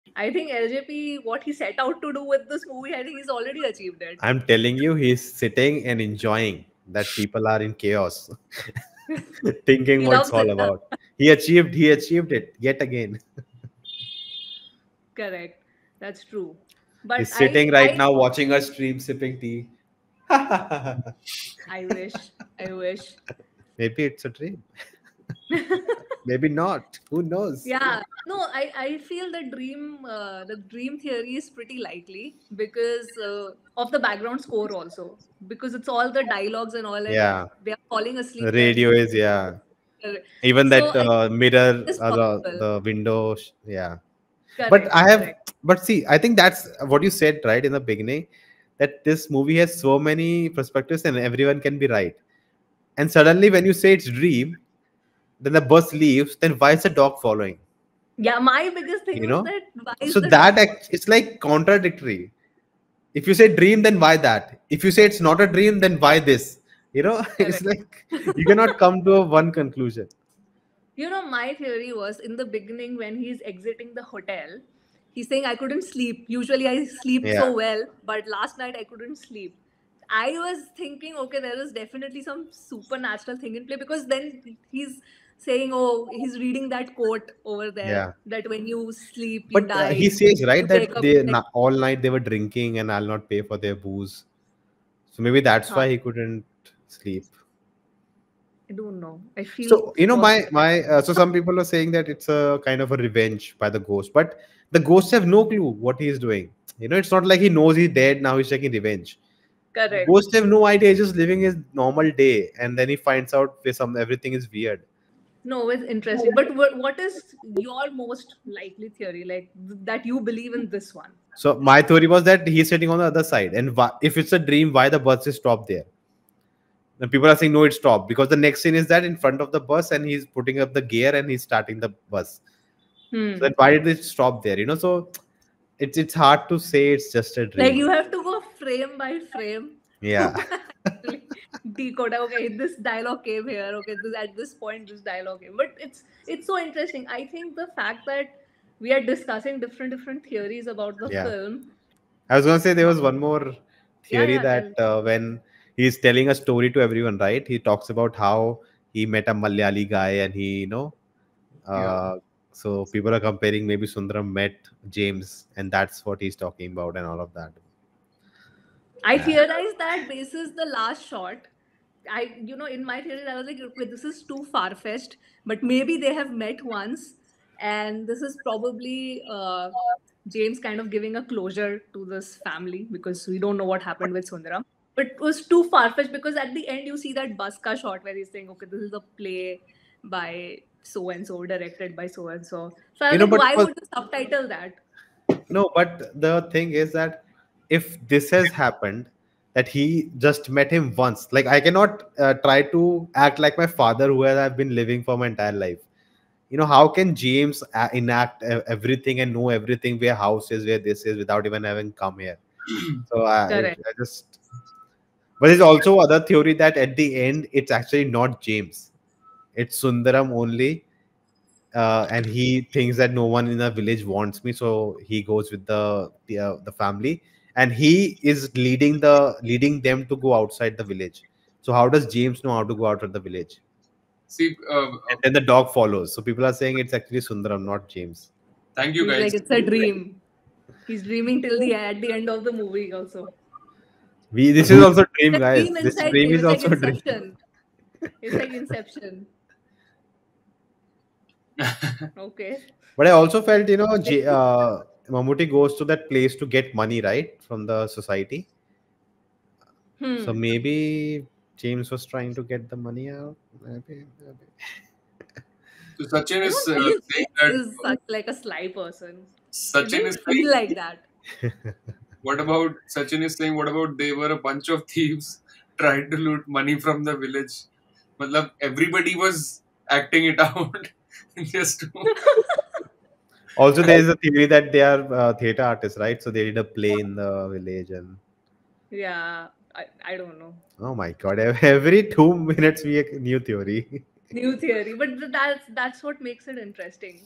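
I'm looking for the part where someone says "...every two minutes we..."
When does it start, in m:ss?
4:51.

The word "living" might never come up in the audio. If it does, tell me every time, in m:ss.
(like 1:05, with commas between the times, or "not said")
1:51, 3:24.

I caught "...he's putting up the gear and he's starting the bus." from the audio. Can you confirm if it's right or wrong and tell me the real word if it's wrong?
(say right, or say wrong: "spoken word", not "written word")
right.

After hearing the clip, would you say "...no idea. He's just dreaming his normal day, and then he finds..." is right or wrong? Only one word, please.
wrong.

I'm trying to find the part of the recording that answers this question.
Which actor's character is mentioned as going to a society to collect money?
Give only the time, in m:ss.
4:15.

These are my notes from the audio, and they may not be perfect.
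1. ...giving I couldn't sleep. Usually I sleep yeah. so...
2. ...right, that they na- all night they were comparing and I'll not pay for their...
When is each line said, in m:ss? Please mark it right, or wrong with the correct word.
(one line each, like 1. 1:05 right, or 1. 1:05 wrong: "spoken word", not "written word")
1. 1:15 wrong: "saying", not "giving"
2. 1:30 wrong: "drinking", not "comparing".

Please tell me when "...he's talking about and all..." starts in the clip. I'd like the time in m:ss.
2:46.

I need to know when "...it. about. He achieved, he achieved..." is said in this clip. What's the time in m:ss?
0:10.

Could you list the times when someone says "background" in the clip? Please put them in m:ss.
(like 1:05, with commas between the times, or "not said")
0:34.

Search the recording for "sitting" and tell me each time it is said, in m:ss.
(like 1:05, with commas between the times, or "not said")
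0:05, 0:17, 2:02.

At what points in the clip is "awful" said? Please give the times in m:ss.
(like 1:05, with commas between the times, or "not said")
not said.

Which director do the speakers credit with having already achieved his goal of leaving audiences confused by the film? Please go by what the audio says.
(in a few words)
LJP.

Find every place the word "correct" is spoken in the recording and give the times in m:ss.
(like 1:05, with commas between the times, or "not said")
0:15, 0:44, 1:07, 1:49.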